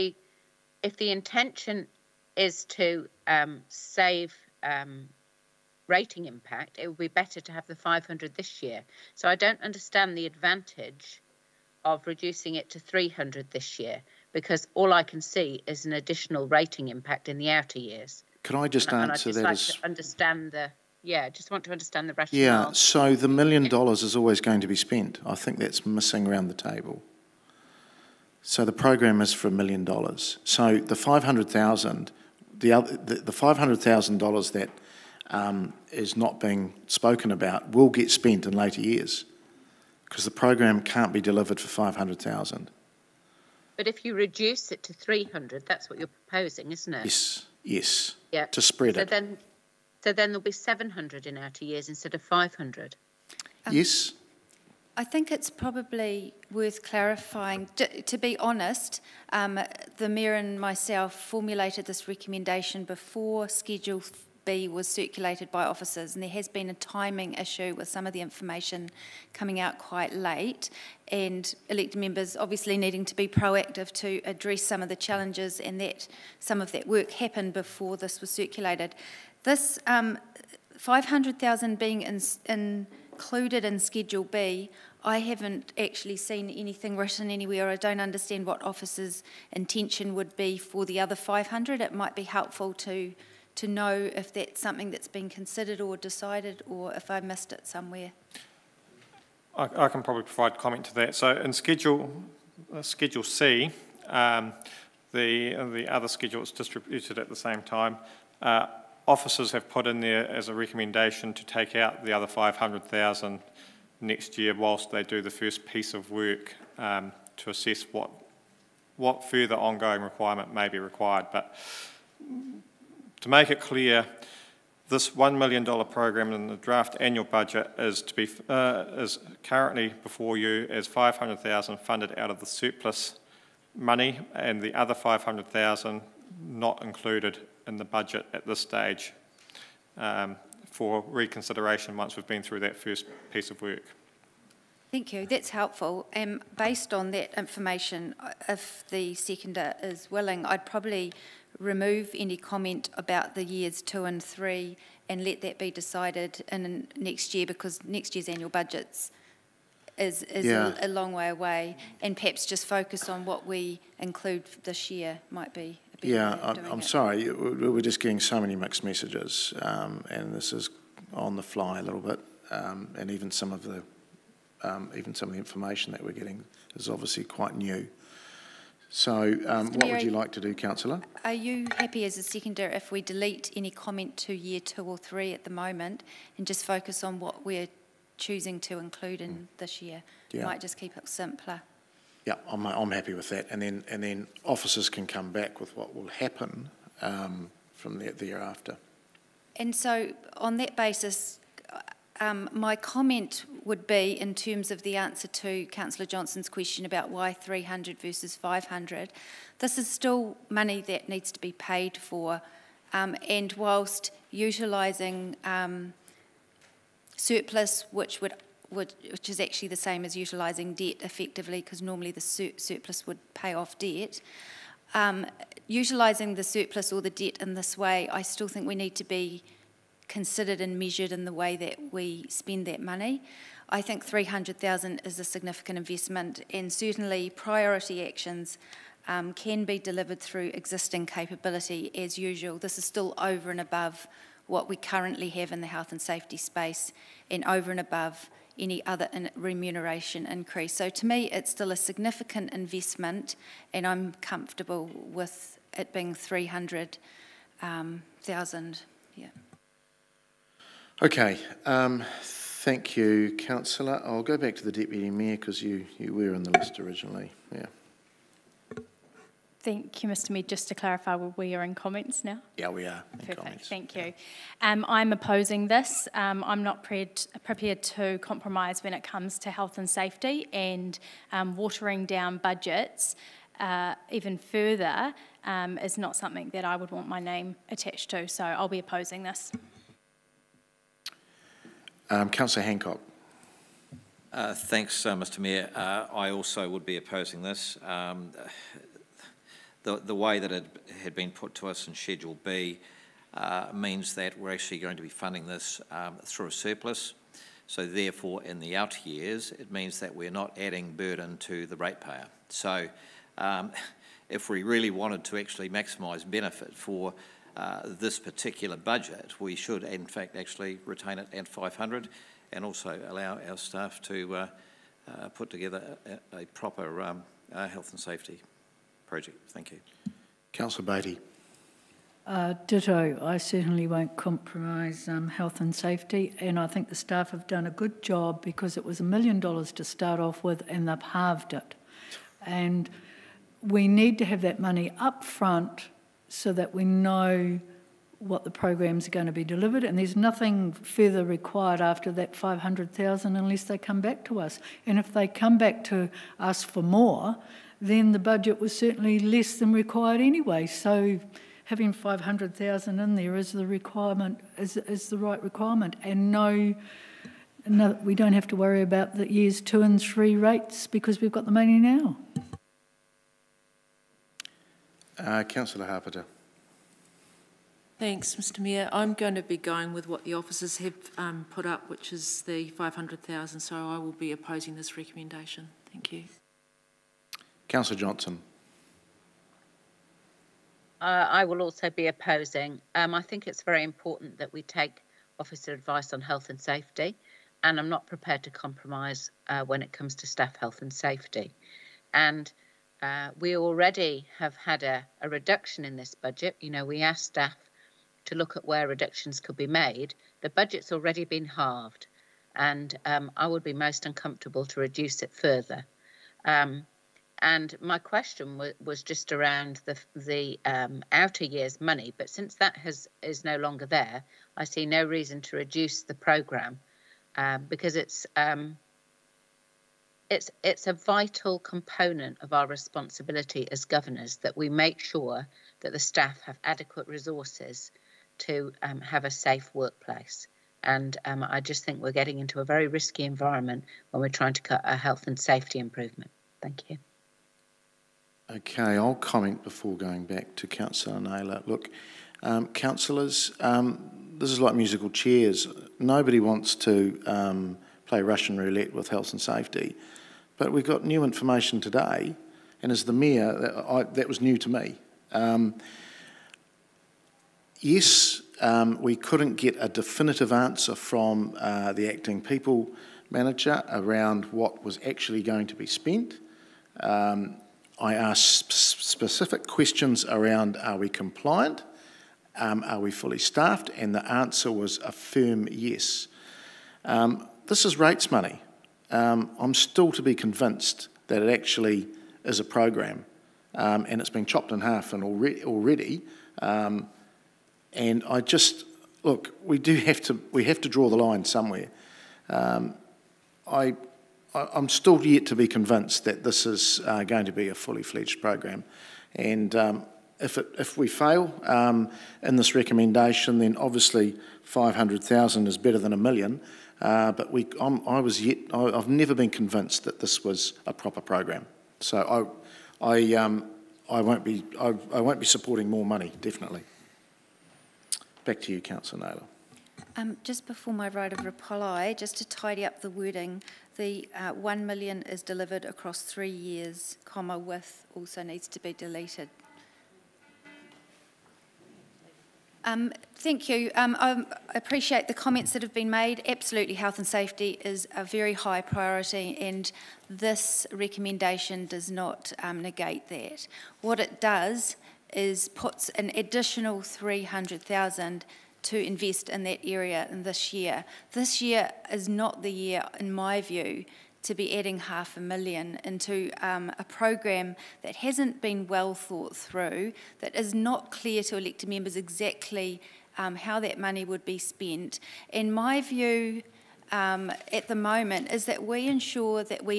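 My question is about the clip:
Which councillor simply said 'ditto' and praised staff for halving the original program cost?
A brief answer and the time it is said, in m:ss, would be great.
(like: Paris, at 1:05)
Councillor Baty, at 5:30.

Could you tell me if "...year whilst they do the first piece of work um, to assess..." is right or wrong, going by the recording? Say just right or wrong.
right.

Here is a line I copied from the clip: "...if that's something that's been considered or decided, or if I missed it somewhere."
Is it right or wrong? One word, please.
right.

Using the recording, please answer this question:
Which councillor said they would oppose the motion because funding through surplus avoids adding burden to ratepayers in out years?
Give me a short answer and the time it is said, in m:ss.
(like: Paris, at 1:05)
Councillor Handcock, at 4:52.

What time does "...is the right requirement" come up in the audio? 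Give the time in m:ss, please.
6:04.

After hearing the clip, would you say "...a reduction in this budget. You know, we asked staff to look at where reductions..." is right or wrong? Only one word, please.
right.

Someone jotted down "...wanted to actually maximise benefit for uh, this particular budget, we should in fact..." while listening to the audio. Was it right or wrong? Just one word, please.
right.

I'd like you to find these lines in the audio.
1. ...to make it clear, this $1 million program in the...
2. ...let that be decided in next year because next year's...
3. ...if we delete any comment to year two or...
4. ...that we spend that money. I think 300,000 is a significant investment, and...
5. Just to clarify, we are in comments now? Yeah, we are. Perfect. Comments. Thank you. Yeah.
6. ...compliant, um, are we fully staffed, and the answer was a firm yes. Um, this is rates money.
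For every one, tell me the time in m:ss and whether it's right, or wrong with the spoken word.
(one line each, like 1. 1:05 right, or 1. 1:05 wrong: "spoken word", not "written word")
1. 2:03 right
2. 2:35 right
3. 3:02 right
4. 3:51 right
5. 4:30 right
6. 8:01 right.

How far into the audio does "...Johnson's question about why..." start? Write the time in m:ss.
3:26.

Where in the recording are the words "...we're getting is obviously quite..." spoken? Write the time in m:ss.
2:56.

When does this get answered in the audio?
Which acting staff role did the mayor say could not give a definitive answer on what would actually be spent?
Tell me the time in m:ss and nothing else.
7:52.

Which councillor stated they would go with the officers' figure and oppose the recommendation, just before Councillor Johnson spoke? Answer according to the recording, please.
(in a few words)
Councillor Hapeta.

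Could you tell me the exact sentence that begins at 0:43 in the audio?
But if you reduce it to three hundred, that's what you're proposing, isn't it?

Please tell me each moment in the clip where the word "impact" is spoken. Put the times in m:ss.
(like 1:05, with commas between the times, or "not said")
0:06, 0:16.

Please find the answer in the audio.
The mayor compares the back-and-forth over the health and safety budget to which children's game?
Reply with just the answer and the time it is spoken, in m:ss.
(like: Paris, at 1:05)
musical chairs, at 7:34.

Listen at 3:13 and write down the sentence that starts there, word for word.
And then, and then officers can come back with what will happen um, from there, thereafter.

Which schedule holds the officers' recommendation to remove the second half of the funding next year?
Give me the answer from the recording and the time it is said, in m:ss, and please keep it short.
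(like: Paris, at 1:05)
Schedule C, at 1:42.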